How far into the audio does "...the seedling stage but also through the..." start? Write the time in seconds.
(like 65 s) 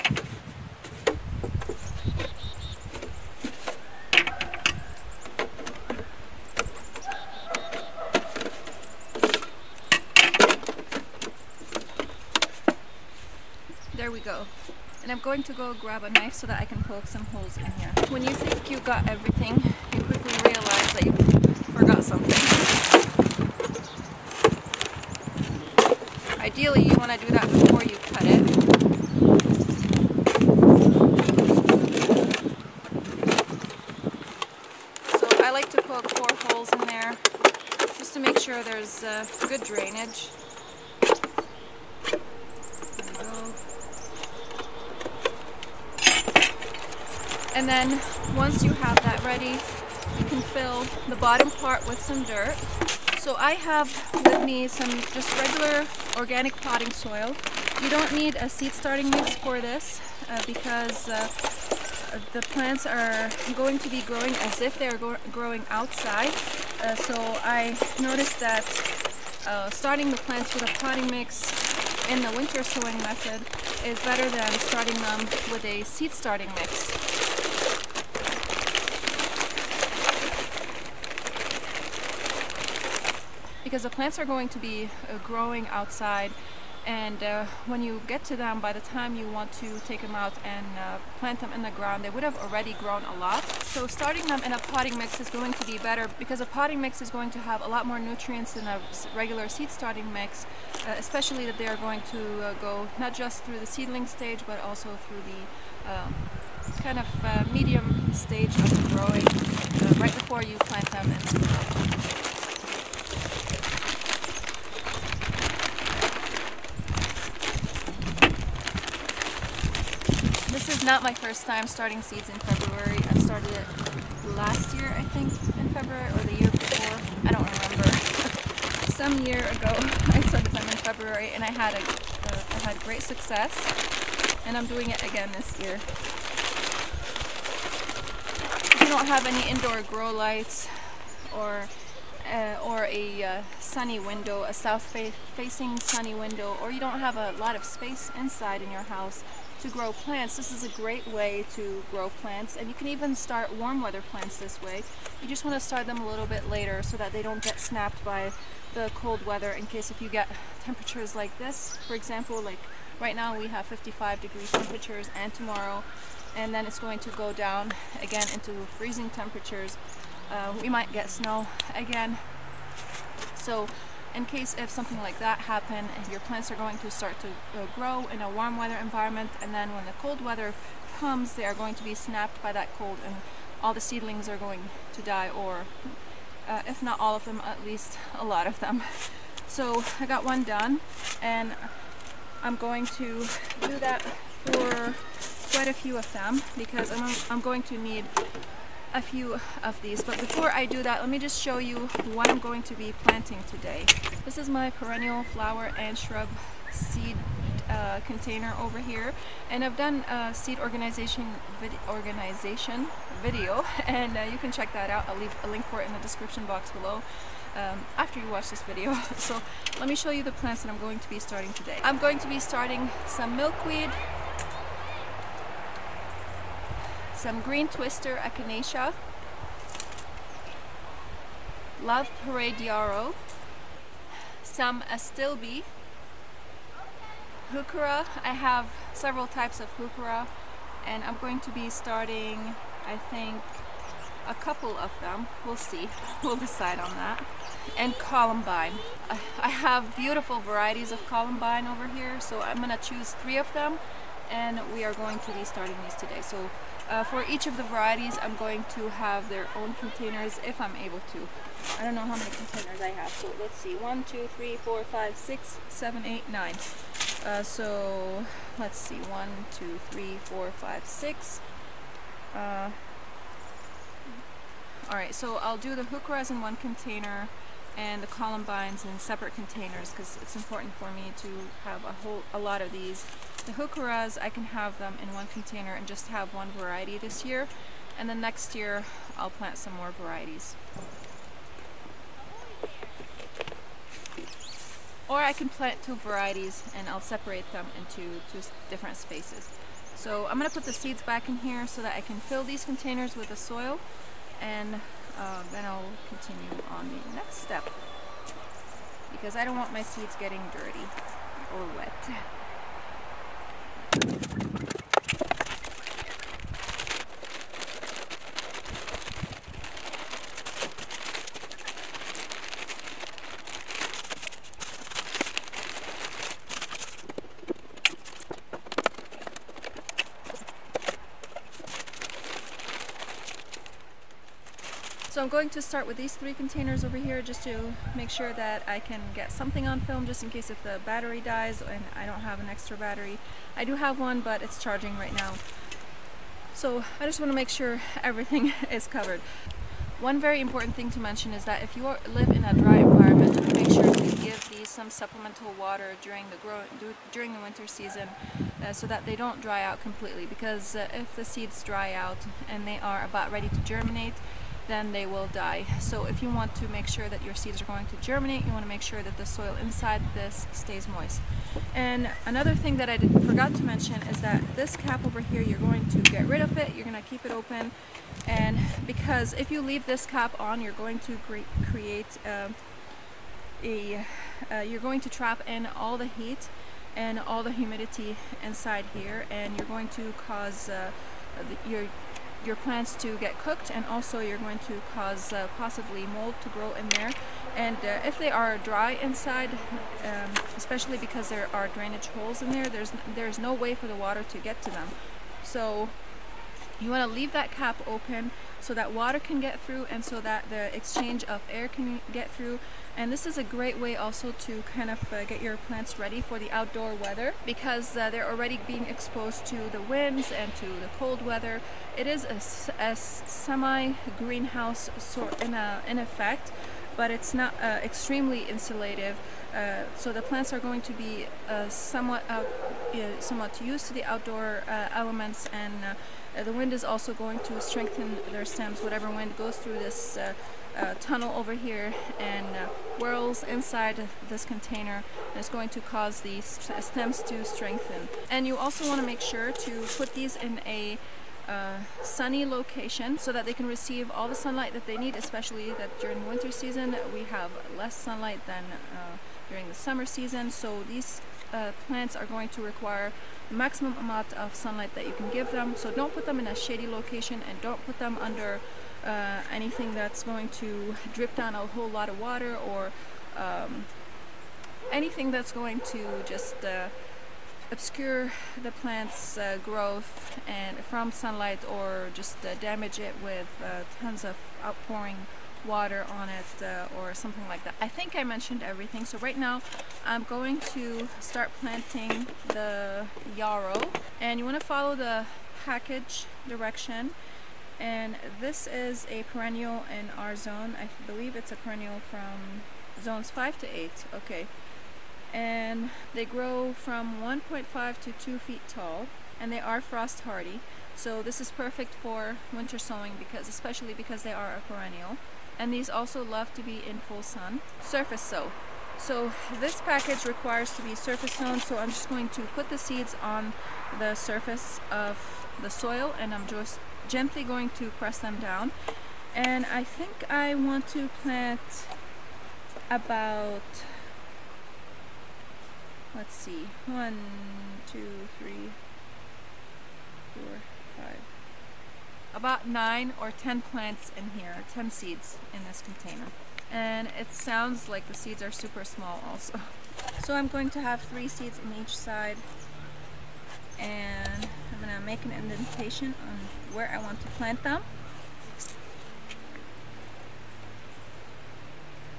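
103 s.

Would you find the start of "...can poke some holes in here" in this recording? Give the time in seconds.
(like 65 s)
16 s.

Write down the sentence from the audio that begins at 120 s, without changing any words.
not my first time starting seeds in February.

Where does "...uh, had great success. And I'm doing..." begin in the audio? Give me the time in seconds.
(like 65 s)
131 s.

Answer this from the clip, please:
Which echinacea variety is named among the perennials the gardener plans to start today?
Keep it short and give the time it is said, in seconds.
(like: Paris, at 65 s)
green twister, at 227 s.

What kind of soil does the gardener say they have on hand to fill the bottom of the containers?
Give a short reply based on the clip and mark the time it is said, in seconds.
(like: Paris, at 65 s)
organic potting soil, at 56 s.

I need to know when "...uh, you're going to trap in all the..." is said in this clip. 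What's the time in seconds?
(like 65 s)
384 s.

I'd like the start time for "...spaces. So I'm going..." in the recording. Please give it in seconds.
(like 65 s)
298 s.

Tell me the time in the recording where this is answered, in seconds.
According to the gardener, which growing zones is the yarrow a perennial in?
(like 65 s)
503 s.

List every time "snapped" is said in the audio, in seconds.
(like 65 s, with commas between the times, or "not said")
157 s, 181 s.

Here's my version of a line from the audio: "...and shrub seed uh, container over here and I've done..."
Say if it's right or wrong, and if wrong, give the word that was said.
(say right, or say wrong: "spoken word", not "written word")
right.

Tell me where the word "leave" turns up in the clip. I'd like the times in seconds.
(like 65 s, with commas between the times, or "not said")
215 s, 379 s, 407 s.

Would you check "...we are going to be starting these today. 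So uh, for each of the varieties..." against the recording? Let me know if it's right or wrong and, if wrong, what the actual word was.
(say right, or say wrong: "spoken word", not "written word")
right.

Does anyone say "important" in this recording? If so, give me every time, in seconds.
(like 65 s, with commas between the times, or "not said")
280 s, 350 s.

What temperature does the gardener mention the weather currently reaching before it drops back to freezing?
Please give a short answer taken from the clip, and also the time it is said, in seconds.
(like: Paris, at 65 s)
55 degrees, at 163 s.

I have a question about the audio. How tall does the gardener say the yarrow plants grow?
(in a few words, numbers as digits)
1.5 to 2 feet.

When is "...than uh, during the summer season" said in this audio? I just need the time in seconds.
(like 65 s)
458 s.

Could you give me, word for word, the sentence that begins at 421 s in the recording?
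It is a, a semi-greenhouse sort in, a, in effect but it's not uh, extremely insulative.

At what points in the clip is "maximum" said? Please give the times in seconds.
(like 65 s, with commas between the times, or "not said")
463 s.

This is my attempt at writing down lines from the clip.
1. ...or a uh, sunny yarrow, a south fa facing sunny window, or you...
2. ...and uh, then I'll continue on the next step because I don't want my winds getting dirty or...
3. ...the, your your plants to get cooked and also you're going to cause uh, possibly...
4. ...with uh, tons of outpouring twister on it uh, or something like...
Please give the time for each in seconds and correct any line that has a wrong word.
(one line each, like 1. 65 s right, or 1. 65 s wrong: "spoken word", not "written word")
1. 142 s wrong: "window", not "yarrow"
2. 304 s wrong: "seeds", not "winds"
3. 391 s right
4. 483 s wrong: "water", not "twister".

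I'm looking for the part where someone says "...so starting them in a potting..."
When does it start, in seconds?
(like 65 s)
93 s.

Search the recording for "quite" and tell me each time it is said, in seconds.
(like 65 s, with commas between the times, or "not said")
195 s.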